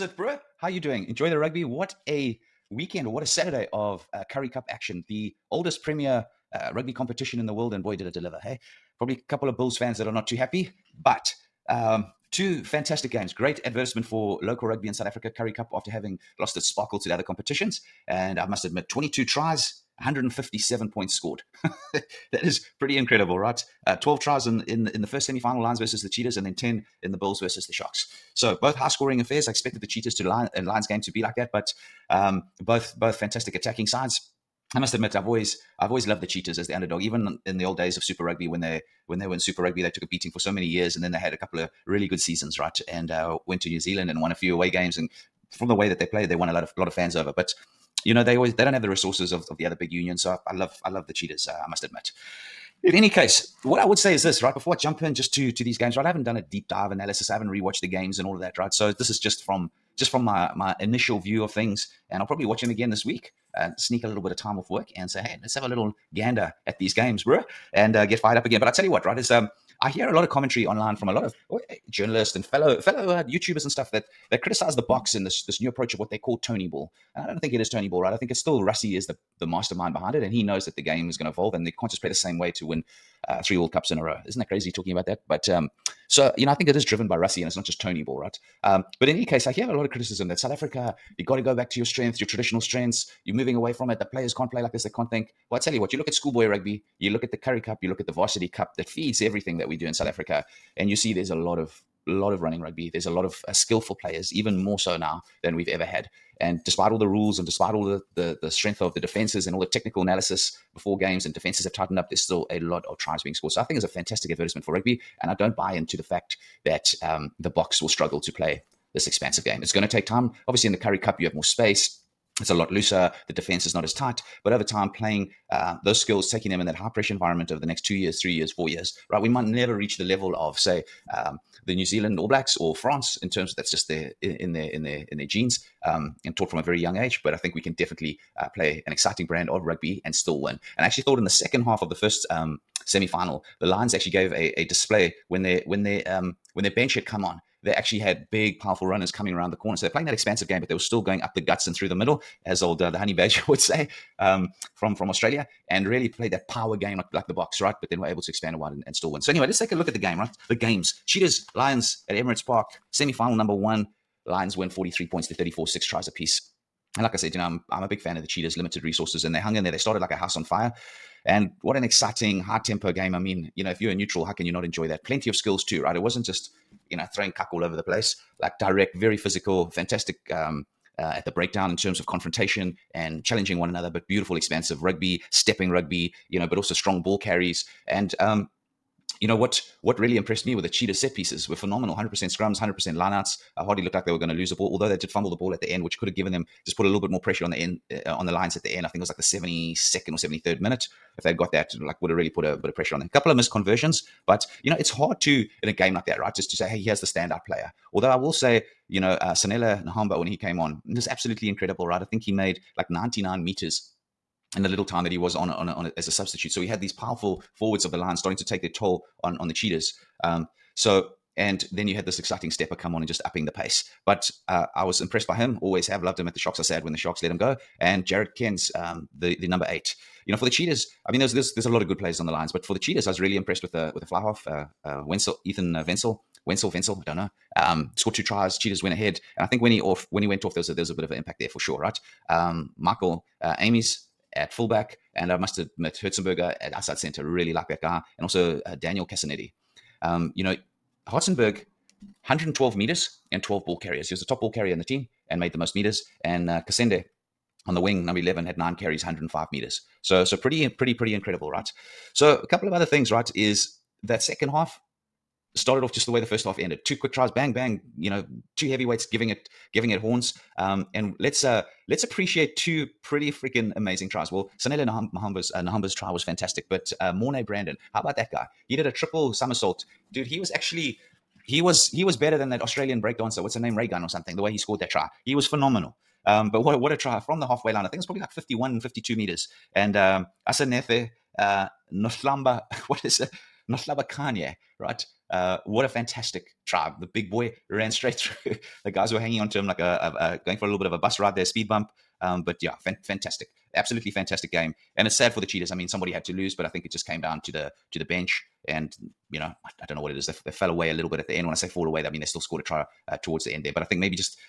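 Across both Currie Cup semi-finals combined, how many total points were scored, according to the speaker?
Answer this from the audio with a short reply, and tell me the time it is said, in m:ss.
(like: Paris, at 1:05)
157, at 0:19.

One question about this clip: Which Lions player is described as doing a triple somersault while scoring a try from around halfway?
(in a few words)
Mornay Brandon.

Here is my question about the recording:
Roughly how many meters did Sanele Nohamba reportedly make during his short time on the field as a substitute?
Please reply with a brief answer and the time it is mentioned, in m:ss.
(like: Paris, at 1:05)
99, at 3:32.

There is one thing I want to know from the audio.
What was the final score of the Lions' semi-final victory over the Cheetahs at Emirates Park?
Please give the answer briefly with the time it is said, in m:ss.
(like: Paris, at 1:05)
43 to 34, at 2:44.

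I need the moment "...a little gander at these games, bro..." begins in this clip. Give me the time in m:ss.
1:05.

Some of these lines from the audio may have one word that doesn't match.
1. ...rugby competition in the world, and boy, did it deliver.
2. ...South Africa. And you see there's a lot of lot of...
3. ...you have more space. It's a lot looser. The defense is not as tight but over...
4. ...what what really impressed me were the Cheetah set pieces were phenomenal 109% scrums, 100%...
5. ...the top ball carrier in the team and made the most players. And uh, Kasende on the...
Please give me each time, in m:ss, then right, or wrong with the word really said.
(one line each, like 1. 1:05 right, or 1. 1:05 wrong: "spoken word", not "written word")
1. 0:06 right
2. 1:39 right
3. 2:01 right
4. 3:09 wrong: "100", not "109"
5. 4:14 wrong: "meters", not "players".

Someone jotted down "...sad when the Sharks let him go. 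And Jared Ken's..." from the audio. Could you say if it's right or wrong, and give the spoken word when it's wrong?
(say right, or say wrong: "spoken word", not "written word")
right.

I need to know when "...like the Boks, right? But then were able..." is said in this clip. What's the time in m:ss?
2:37.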